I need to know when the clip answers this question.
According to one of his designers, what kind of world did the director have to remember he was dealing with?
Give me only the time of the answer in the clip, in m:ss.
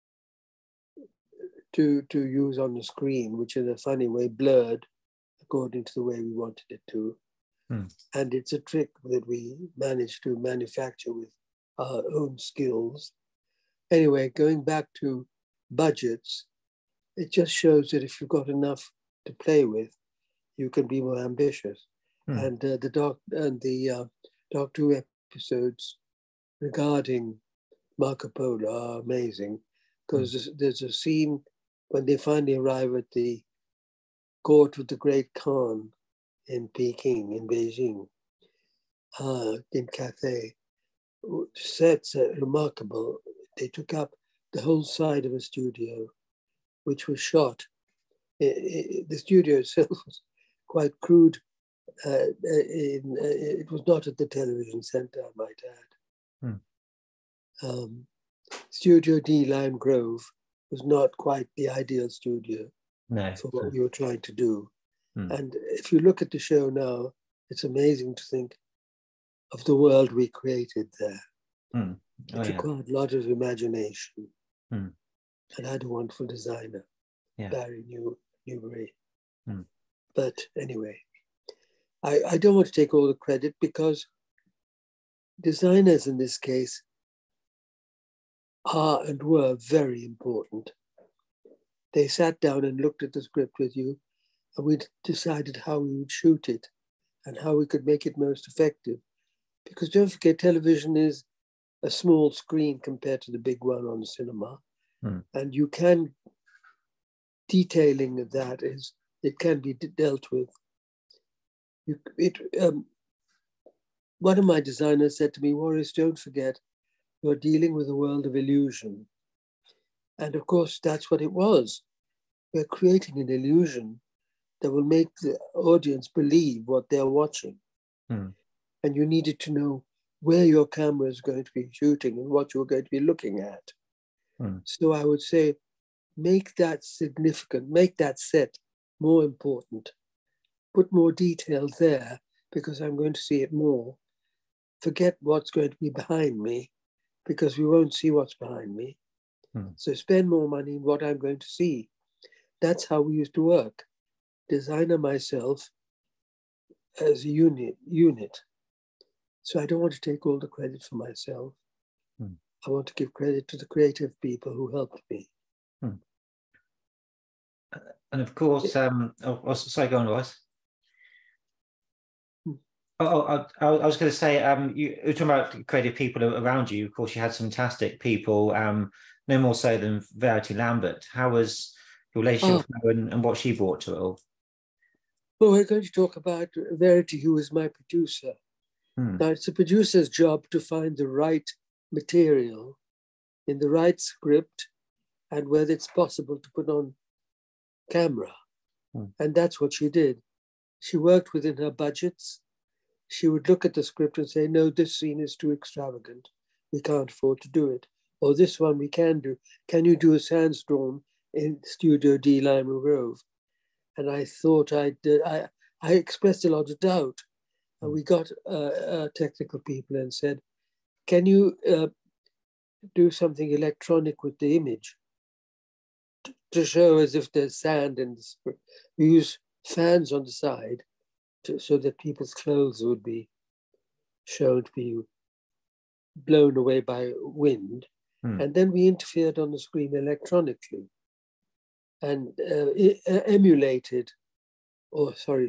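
1:57.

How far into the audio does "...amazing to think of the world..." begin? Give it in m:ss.
1:07.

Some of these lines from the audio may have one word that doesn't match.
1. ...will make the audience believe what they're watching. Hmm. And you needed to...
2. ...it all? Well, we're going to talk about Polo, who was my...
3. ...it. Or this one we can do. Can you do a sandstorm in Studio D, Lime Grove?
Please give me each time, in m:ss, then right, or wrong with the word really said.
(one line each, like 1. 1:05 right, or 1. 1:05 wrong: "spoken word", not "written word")
1. 2:04 right
2. 3:03 wrong: "Verity", not "Polo"
3. 3:27 right.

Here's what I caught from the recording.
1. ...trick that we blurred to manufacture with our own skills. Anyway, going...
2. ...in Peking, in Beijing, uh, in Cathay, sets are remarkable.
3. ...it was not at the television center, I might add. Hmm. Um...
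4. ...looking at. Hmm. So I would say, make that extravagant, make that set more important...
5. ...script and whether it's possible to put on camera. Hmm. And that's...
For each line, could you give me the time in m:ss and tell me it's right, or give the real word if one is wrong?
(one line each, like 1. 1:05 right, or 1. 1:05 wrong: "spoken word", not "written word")
1. 0:08 wrong: "managed", not "blurred"
2. 0:36 right
3. 0:53 right
4. 2:13 wrong: "significant", not "extravagant"
5. 3:14 right.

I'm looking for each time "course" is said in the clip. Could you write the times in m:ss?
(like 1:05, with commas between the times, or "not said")
2:00, 2:48, 2:56.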